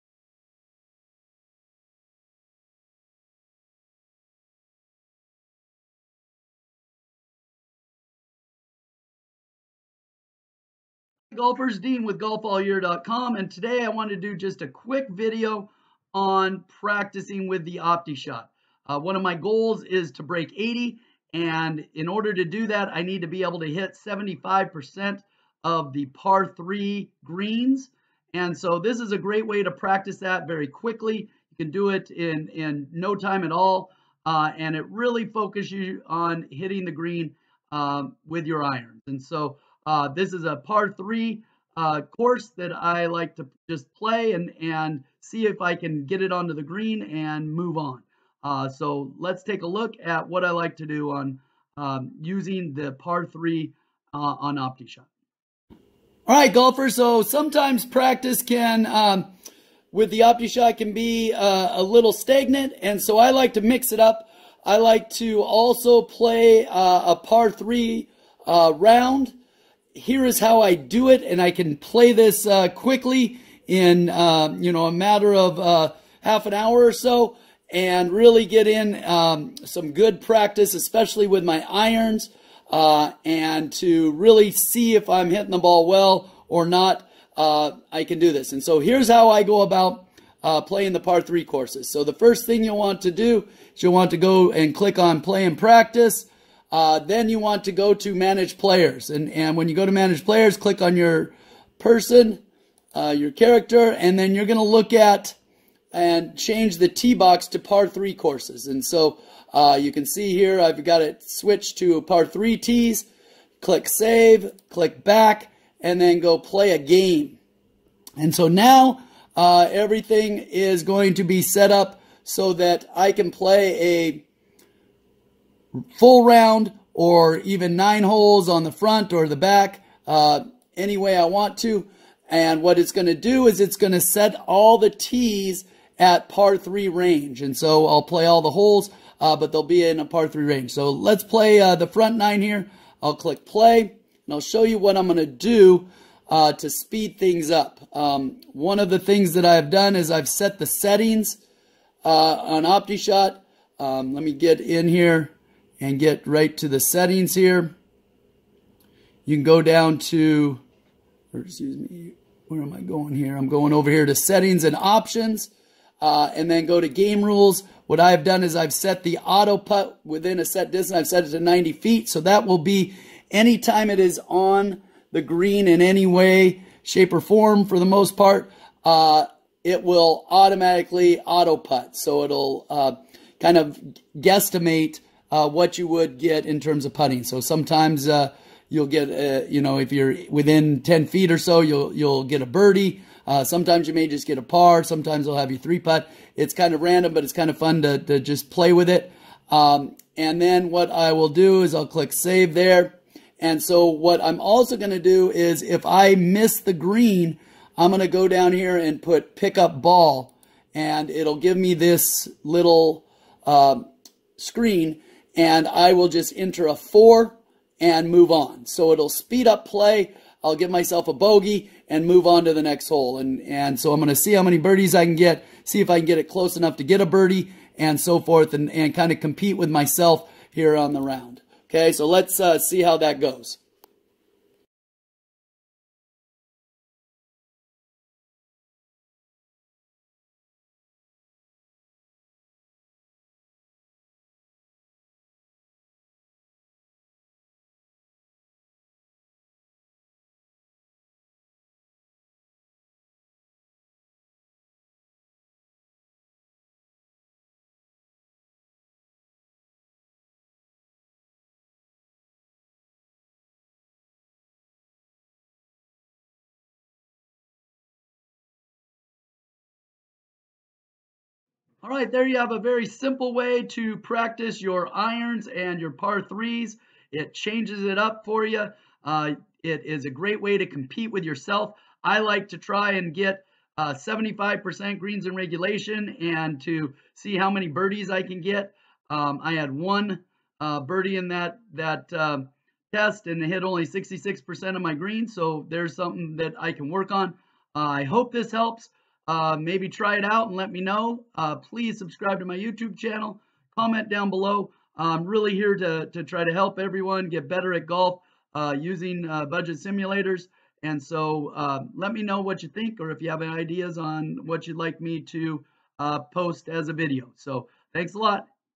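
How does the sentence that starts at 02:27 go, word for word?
Um, one of the things that I've done is I've set the settings uh, on OptiShot.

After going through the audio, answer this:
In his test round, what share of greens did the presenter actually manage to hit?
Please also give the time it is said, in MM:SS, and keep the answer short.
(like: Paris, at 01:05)
66%, at 04:53.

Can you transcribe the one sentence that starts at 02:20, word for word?
So let's play uh, the front nine here.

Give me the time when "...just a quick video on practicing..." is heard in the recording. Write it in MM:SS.
00:14.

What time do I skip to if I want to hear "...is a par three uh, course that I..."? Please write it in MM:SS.
00:40.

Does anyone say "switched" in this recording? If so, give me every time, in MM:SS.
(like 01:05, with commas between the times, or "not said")
01:51.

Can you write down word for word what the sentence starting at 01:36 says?
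Uh, then you want to go to manage players.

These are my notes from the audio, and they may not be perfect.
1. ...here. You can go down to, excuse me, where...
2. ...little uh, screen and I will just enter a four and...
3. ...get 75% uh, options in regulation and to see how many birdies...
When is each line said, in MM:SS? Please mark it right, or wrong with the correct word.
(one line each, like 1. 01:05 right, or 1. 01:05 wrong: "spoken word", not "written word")
1. 02:37 right
2. 03:32 right
3. 04:43 wrong: "greens", not "options".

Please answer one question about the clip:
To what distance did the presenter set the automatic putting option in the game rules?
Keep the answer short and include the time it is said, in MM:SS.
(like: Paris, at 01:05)
90 feet, at 02:51.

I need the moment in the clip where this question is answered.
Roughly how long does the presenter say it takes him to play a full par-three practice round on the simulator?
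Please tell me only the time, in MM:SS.
01:16.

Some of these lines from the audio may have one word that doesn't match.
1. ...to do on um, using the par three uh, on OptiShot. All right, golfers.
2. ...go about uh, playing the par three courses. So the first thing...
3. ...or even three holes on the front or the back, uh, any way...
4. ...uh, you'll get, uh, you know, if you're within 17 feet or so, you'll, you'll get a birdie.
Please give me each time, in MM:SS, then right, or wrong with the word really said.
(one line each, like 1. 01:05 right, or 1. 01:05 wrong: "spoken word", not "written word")
1. 00:50 right
2. 01:29 right
3. 02:06 wrong: "nine", not "three"
4. 03:08 wrong: "10", not "17".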